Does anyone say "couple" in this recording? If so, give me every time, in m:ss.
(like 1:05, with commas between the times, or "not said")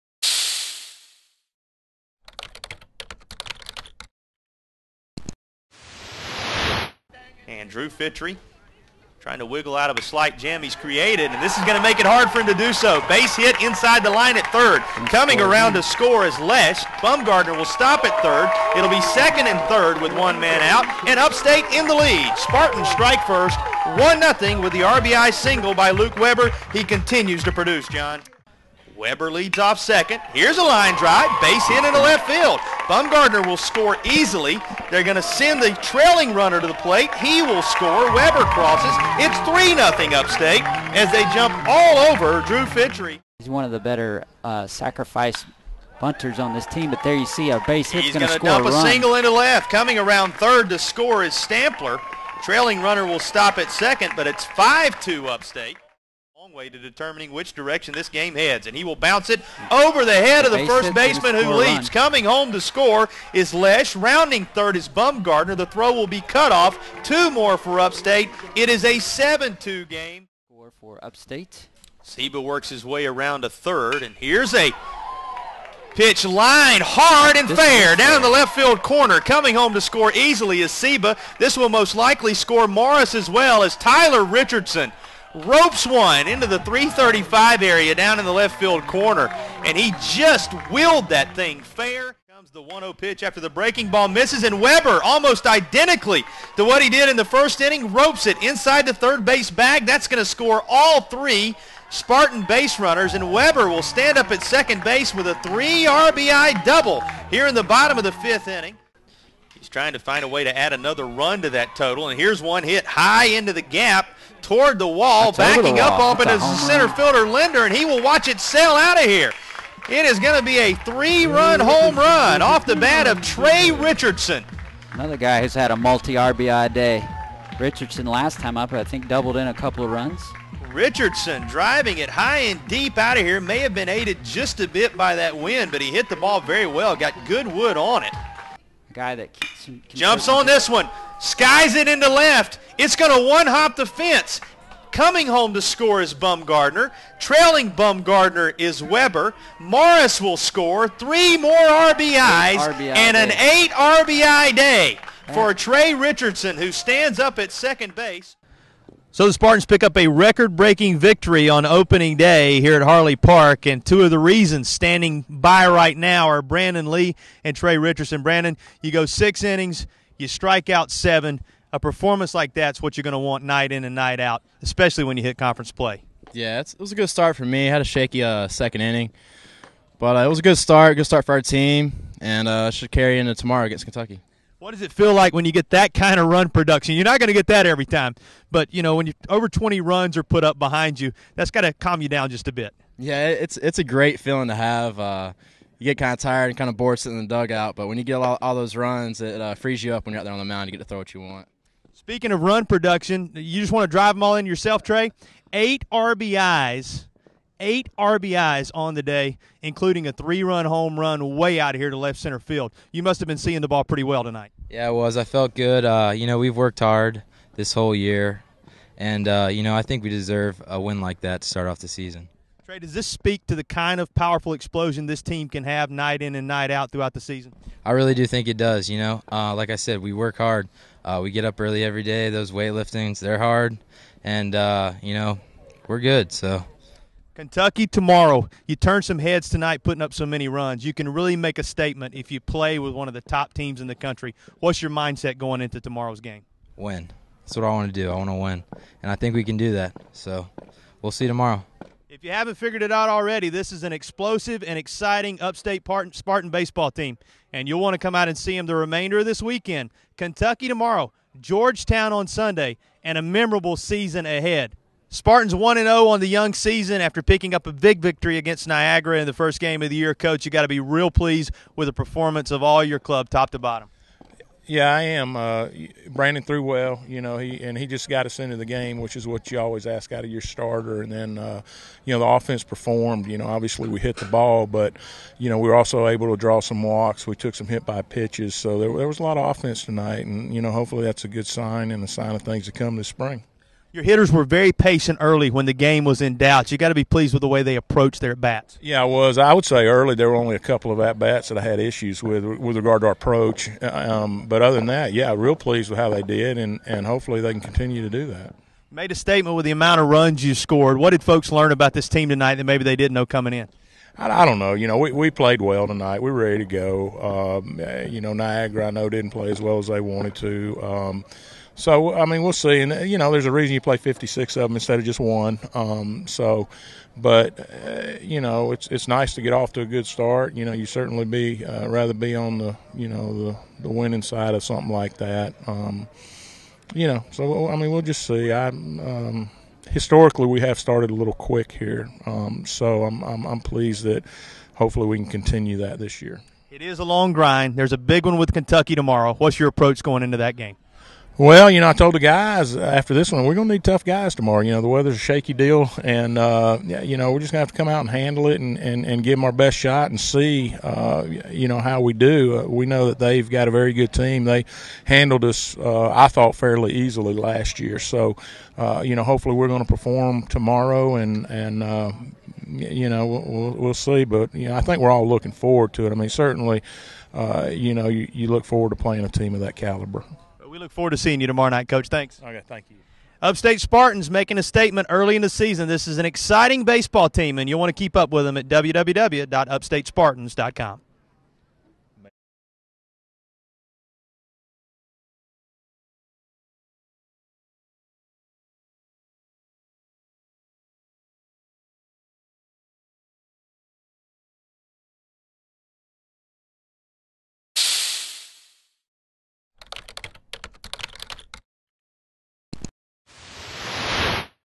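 2:09, 5:00.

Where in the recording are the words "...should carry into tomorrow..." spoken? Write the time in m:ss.
3:02.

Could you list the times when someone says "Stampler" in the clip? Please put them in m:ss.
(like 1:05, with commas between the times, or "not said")
0:51.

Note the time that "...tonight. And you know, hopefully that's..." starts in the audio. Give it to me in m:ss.
4:49.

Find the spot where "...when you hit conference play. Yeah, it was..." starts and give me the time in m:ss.
2:55.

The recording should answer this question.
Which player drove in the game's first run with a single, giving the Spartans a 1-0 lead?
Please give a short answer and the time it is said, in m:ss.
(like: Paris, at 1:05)
Luke Weber, at 0:25.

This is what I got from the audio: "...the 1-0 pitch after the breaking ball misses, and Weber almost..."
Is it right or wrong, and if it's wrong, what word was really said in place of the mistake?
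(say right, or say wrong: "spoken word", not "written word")
right.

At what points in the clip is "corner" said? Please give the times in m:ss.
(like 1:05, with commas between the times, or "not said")
1:18, 1:28.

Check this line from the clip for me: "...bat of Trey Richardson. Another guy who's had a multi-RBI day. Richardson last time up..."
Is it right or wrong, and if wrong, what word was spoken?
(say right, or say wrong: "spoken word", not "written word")
right.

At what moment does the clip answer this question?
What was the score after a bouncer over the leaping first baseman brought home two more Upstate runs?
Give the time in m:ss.
1:08.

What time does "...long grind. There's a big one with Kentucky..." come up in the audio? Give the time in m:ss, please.
5:47.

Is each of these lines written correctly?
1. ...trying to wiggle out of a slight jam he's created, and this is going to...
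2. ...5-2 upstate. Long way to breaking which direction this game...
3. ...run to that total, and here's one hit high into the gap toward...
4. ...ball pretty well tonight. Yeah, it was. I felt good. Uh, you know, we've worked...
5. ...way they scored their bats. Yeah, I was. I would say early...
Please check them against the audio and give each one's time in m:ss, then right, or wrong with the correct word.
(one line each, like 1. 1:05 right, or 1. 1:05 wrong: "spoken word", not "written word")
1. 0:09 right
2. 0:54 wrong: "determining", not "breaking"
3. 1:51 right
4. 3:33 right
5. 4:57 wrong: "approached", not "scored".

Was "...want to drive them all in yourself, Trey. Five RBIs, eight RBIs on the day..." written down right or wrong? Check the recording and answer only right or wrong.
wrong.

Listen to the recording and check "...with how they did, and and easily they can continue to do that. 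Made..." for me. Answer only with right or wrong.
wrong.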